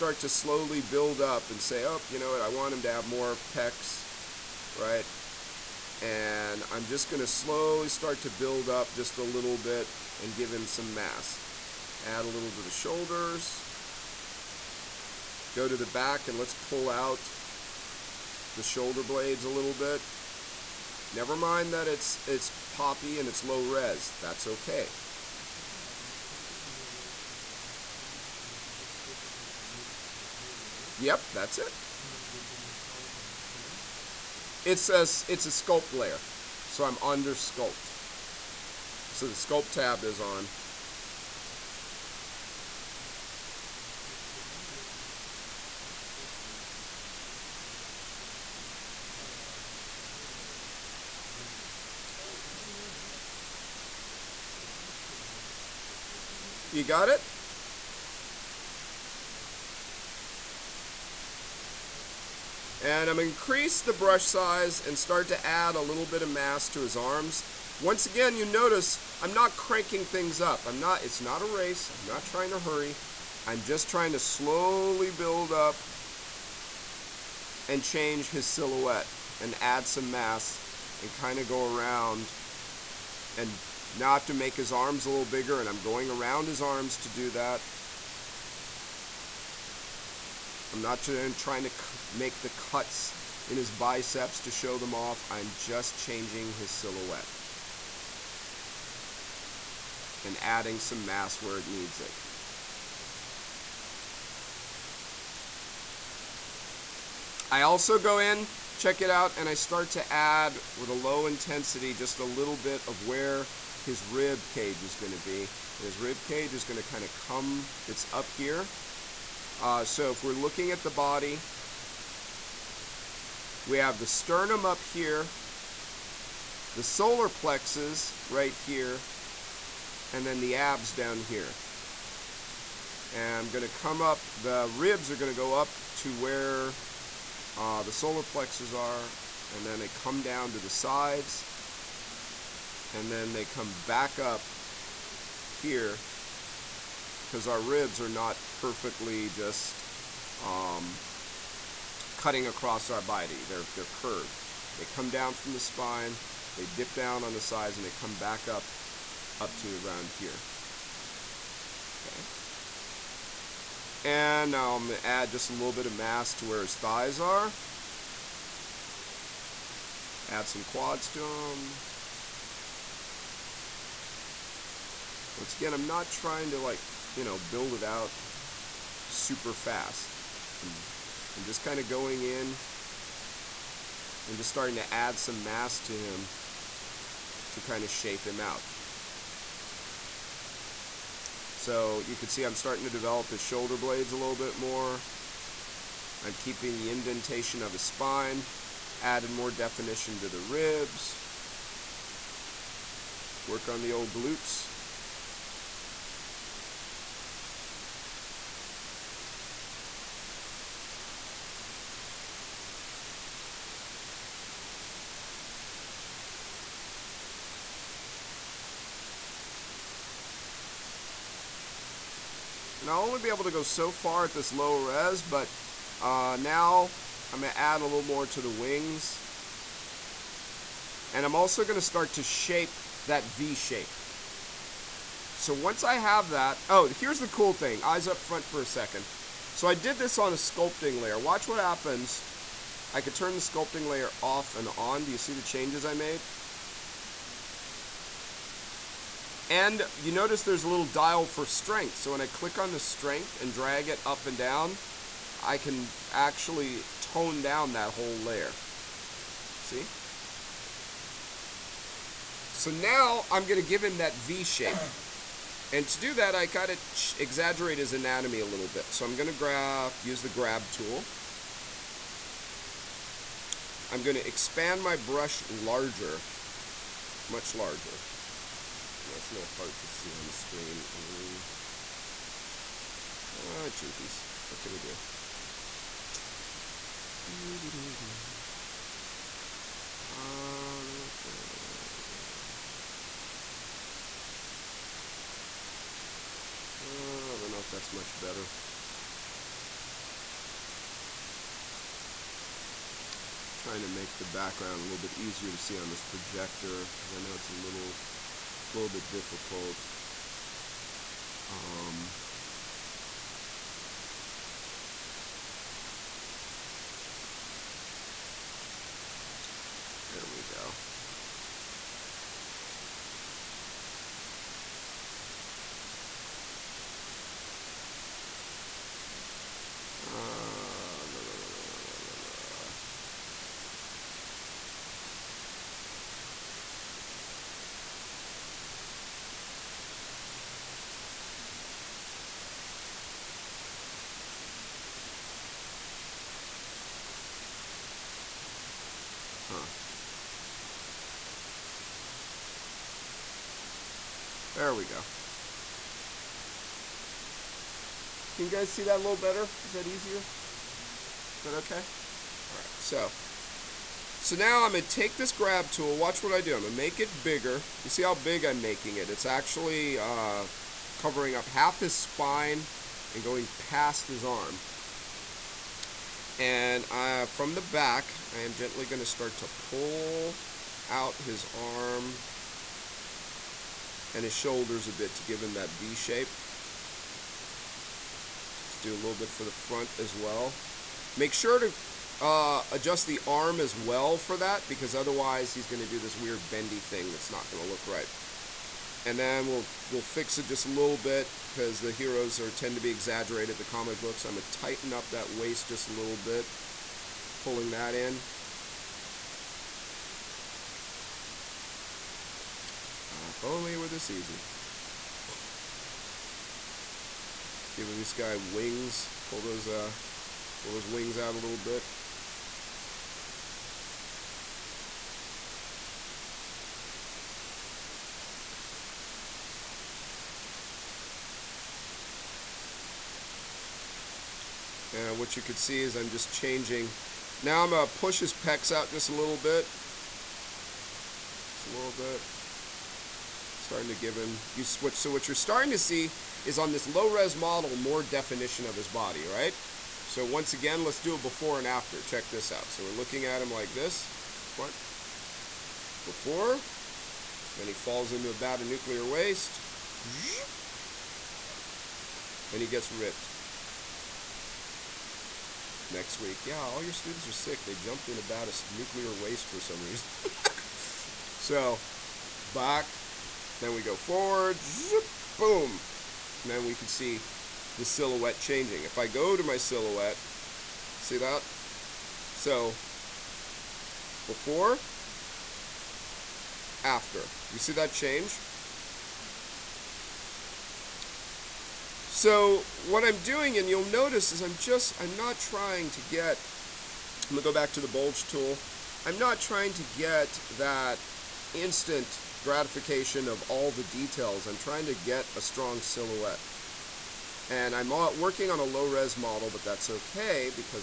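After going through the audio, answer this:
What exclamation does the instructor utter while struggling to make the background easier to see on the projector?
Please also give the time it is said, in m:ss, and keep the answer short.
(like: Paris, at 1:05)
jinkies, at 4:43.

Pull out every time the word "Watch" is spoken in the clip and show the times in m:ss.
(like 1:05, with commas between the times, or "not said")
4:01, 6:05.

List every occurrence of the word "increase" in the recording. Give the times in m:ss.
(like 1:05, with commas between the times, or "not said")
1:03.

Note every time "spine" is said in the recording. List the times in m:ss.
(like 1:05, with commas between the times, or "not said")
2:35, 3:17, 6:11.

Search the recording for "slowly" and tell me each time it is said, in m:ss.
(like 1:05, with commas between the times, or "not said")
0:00, 0:07, 1:14.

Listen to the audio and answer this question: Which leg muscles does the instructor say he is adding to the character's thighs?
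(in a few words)
quads.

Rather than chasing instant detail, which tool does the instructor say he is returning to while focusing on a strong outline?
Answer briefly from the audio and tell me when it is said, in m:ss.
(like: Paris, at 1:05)
bulge tool, at 8:17.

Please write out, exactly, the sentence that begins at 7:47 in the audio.
They jumped in a bad of nuclear waste for some reason.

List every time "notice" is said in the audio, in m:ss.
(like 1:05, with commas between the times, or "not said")
1:08, 4:10, 8:13.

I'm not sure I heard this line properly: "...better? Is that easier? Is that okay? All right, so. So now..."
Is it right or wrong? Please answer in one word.
right.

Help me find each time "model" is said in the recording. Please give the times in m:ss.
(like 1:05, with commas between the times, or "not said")
7:27, 8:29.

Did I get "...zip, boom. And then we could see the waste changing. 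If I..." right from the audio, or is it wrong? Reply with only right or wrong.
wrong.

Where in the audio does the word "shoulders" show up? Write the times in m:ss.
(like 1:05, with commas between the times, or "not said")
0:12, 0:18, 3:13, 6:24.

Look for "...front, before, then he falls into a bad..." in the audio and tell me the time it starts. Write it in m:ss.
7:34.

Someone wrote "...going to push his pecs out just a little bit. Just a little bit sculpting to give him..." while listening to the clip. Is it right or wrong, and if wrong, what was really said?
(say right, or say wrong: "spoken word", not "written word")
wrong: "starting", not "sculpting".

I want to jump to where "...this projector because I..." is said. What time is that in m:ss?
5:05.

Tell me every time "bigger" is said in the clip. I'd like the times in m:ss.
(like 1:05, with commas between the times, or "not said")
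1:25, 6:07.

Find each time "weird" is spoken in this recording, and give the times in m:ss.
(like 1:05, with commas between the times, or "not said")
6:36.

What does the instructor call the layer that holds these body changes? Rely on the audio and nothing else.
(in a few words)
sculpt layer.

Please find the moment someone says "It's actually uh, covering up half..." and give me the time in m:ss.
6:09.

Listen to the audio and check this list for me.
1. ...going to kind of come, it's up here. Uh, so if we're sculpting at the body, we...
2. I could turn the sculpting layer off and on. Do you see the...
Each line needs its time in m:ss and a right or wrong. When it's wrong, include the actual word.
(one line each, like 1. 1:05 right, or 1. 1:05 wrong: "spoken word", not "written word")
1. 1:56 wrong: "looking", not "sculpting"
2. 4:02 right.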